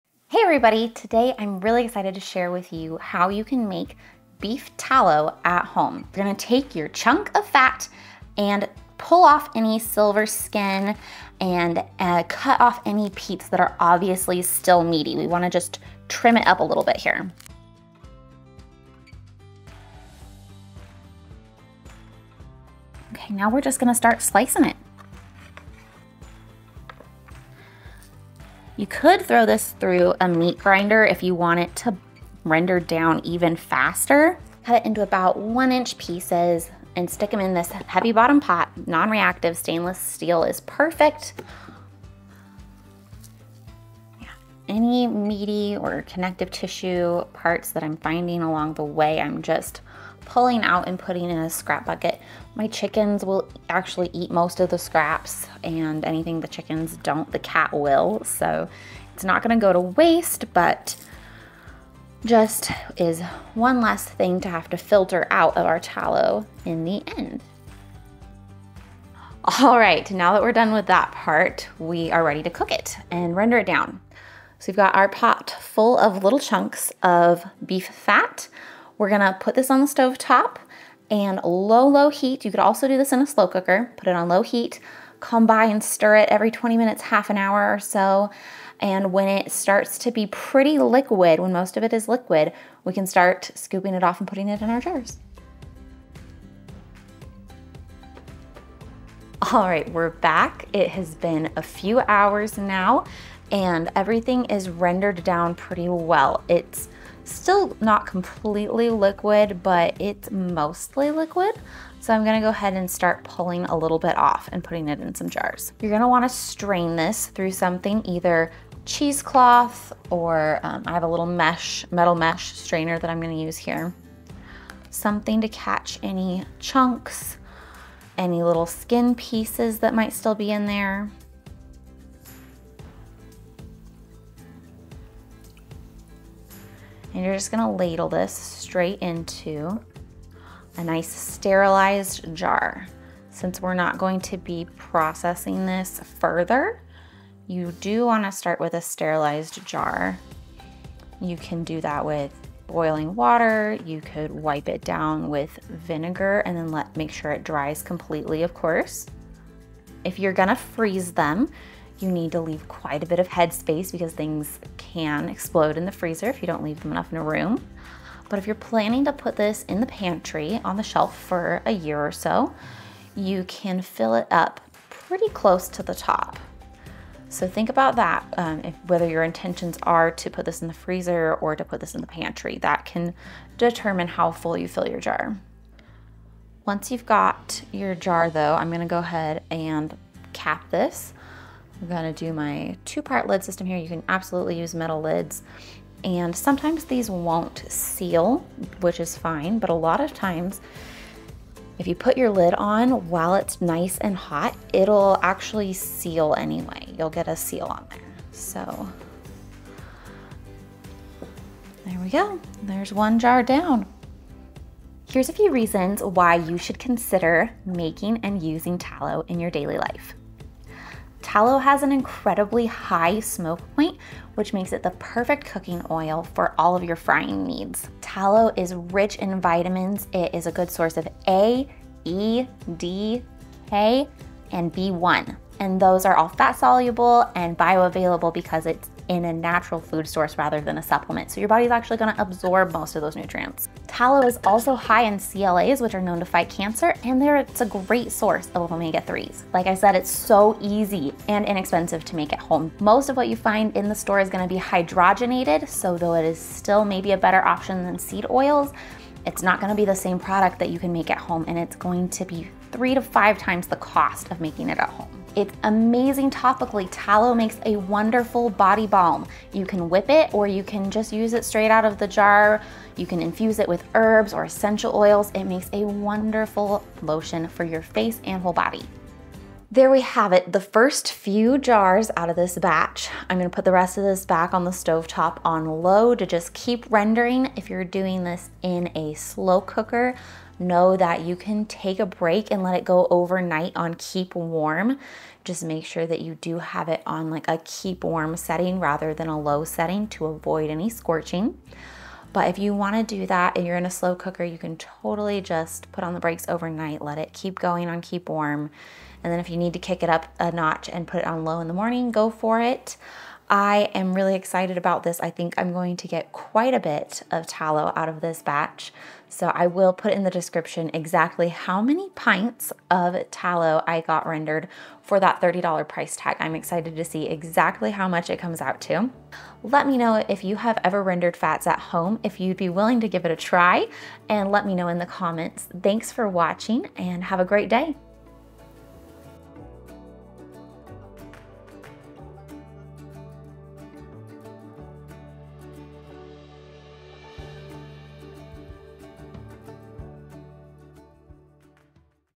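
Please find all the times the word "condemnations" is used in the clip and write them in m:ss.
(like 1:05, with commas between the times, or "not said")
not said.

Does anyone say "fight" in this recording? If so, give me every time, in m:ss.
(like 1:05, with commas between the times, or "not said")
4:06.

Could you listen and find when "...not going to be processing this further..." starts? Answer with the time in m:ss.
2:23.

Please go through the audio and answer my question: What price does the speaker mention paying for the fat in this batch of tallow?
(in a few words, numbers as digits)
$30.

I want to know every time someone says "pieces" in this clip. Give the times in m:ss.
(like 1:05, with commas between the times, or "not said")
0:35, 2:09.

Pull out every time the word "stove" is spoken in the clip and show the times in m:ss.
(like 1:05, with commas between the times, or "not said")
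1:19, 4:44.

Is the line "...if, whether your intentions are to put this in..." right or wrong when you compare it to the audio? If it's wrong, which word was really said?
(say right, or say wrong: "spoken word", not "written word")
right.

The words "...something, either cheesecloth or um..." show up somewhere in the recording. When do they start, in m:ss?
1:57.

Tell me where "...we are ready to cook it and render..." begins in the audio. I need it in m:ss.
1:11.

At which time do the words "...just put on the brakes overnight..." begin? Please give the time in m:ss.
5:05.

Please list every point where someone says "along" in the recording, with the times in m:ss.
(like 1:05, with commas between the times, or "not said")
0:48.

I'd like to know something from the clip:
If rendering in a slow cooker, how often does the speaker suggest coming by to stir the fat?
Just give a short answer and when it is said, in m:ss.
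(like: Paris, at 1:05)
every 20 minutes, at 1:26.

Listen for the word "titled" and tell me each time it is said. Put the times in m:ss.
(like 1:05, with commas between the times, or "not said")
not said.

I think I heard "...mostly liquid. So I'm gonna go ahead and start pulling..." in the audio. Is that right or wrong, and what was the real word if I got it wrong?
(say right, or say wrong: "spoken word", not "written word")
right.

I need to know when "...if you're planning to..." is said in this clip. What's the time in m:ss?
2:48.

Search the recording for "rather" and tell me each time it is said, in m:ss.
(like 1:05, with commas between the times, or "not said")
4:00, 4:58.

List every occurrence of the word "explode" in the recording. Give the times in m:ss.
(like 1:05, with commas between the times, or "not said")
2:45.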